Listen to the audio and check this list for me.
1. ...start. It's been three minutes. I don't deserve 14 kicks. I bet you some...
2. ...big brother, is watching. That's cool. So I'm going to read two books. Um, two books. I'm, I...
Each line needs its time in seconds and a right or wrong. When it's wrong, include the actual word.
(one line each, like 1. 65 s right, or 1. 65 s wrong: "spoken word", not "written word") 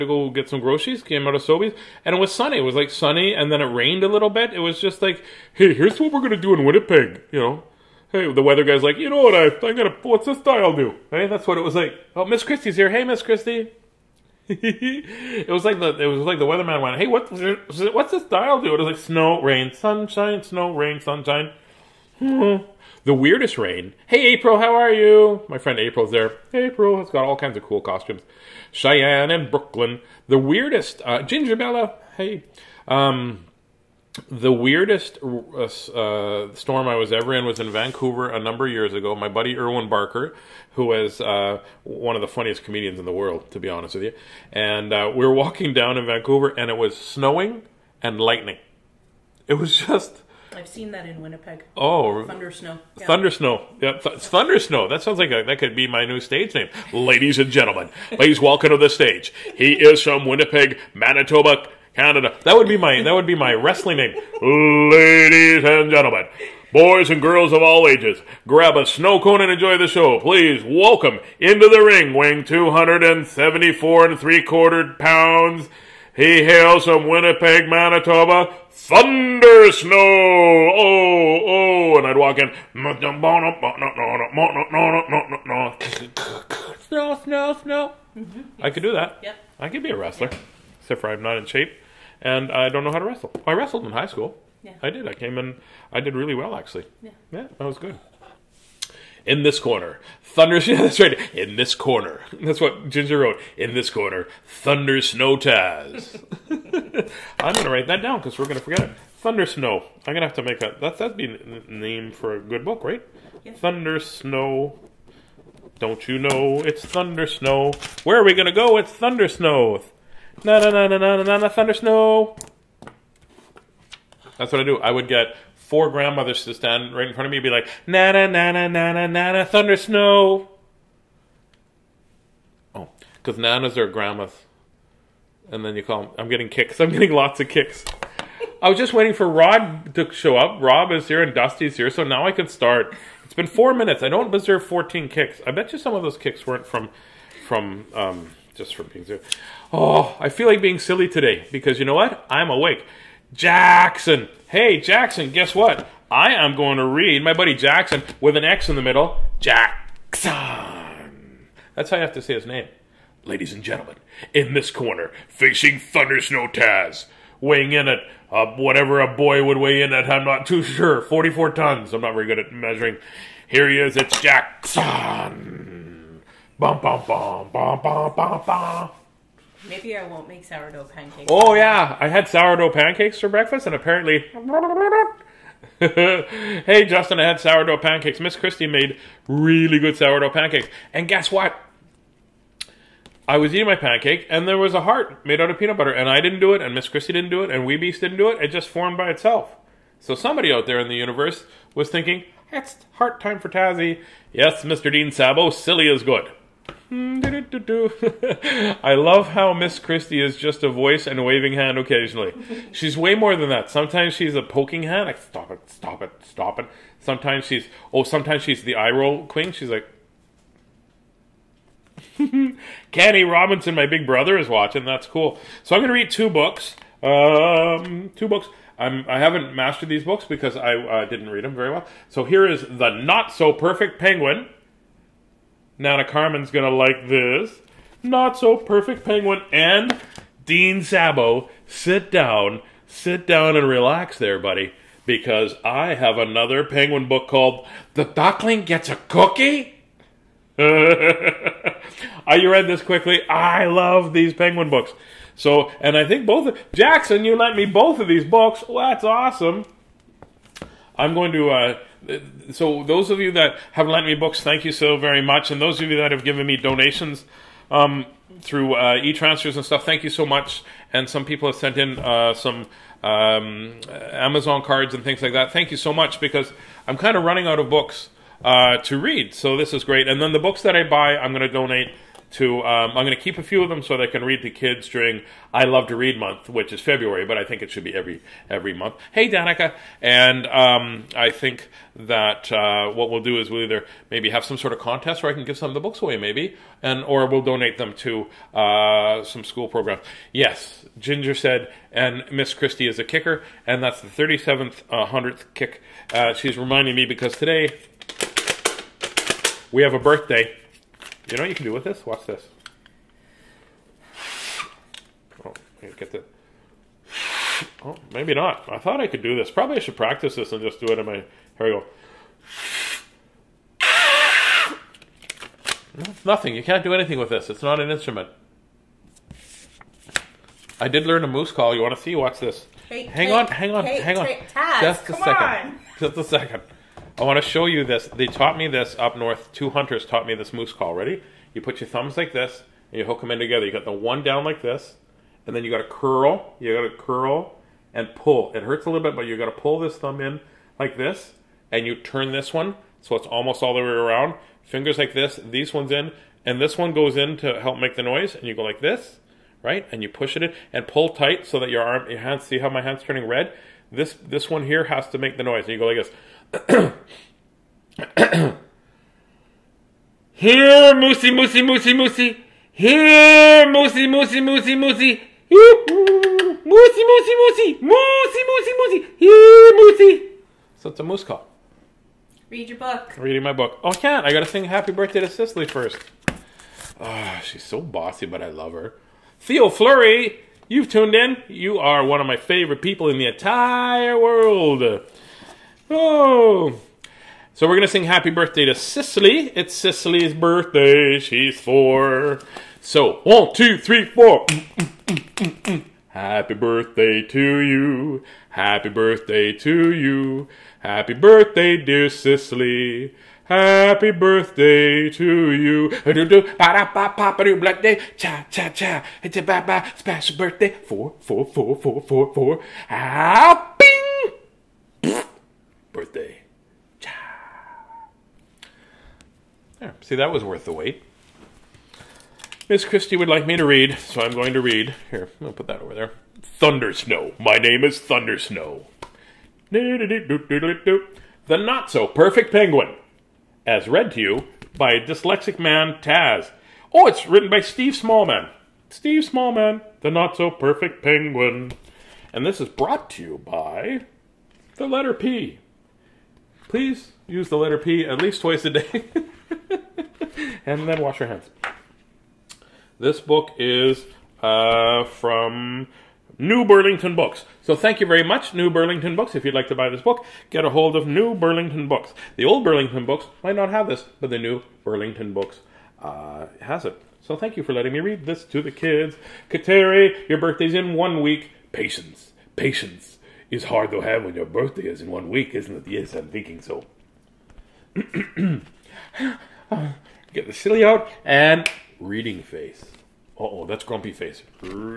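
1. 142 s wrong: "four", not "three"
2. 223 s right.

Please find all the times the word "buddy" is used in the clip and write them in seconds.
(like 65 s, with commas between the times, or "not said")
39 s, 157 s, 244 s.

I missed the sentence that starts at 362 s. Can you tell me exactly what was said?
See how my hands turning red?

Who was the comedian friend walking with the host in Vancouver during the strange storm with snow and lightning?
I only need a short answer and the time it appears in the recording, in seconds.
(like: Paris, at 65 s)
Irwin Barker, at 39 s.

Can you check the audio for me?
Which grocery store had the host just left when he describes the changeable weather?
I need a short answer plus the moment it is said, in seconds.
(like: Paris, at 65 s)
Sobeys, at 1 s.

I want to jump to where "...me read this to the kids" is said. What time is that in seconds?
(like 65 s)
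477 s.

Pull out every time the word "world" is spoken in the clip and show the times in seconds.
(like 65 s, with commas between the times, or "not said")
43 s, 394 s.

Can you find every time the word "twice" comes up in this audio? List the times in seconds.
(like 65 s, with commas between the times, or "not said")
458 s.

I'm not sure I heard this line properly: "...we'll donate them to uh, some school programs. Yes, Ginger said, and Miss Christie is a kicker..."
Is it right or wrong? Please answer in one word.
right.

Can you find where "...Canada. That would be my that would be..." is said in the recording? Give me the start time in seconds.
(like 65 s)
61 s.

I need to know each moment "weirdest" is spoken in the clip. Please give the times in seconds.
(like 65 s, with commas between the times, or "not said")
23 s, 30 s, 34 s.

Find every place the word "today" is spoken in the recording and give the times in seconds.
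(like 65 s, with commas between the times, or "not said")
151 s, 307 s.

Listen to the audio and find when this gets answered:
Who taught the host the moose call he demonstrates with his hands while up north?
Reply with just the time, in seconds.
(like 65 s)
339 s.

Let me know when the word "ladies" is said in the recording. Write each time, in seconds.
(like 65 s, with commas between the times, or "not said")
56 s, 64 s, 163 s.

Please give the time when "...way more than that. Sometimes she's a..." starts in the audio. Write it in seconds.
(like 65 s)
212 s.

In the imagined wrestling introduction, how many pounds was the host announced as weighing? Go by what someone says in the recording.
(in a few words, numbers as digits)
274 and three quarter pounds.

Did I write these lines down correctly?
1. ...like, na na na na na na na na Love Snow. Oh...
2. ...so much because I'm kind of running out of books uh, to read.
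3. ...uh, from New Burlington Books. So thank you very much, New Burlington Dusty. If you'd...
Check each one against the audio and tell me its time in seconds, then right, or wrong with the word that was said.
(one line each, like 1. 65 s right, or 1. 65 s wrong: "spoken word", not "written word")
1. 127 s wrong: "Thunder", not "Love"
2. 275 s right
3. 464 s wrong: "Books", not "Dusty".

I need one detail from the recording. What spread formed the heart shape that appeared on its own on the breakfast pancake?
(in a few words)
Peanut butter.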